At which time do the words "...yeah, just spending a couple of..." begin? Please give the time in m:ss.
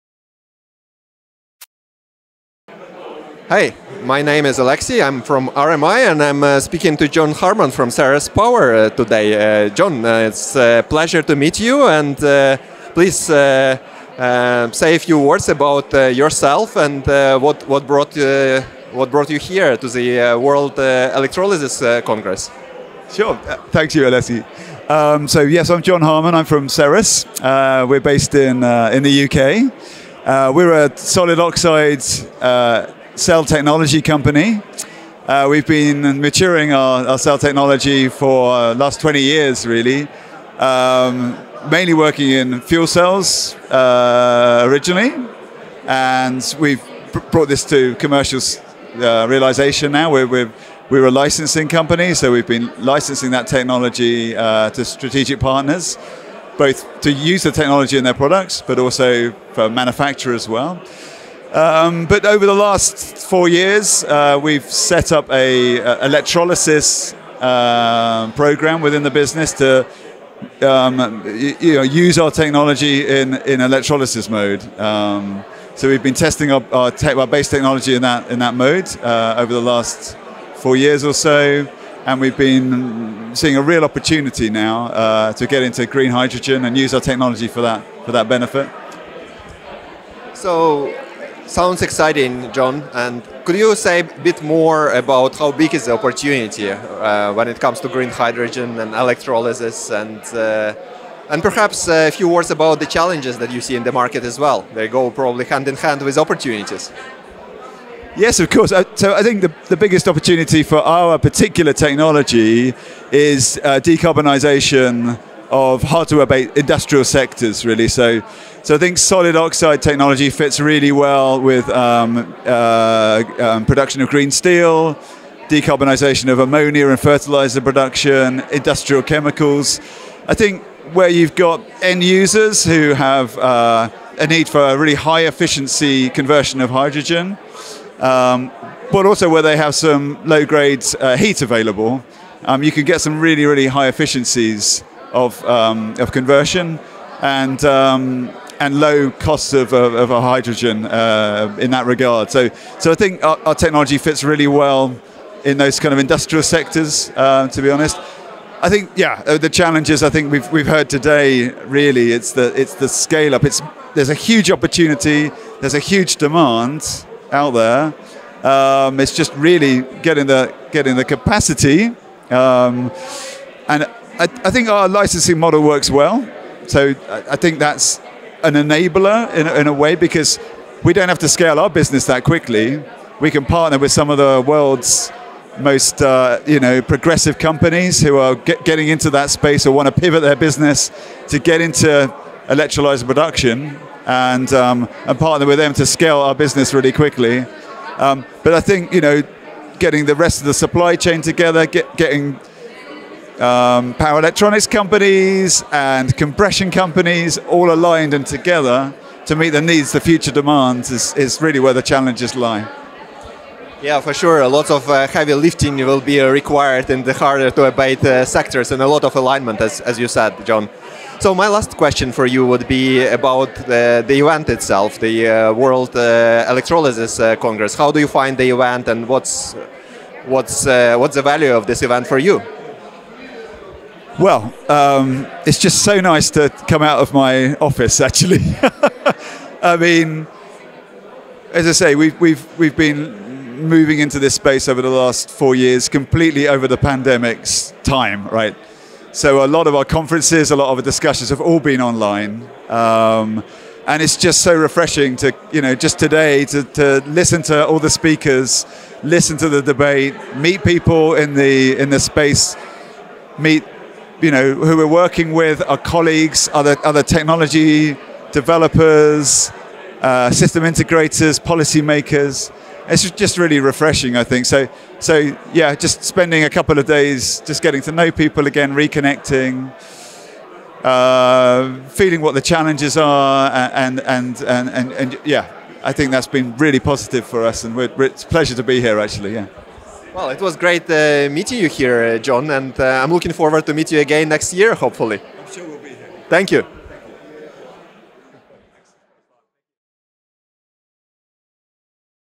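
4:35.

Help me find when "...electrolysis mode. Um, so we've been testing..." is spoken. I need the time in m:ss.
1:13.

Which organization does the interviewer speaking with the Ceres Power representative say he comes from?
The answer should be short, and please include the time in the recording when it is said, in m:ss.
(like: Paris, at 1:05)
RMI, at 0:05.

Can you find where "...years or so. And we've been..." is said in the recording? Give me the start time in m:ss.
1:20.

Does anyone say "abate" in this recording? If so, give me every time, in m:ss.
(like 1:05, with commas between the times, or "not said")
1:55, 3:37.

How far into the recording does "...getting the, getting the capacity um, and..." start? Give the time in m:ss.
2:50.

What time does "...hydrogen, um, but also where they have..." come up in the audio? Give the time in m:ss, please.
2:16.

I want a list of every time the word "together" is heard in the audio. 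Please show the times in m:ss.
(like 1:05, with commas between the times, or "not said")
3:21, 3:28.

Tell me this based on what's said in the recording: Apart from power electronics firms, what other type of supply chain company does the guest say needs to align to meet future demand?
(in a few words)
compression companies.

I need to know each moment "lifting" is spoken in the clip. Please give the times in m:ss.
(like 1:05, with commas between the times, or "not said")
3:35.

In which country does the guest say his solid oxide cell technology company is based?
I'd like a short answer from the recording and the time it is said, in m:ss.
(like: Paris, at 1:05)
UK, at 0:29.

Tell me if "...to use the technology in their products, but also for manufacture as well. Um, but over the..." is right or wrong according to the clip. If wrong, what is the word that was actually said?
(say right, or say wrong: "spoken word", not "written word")
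right.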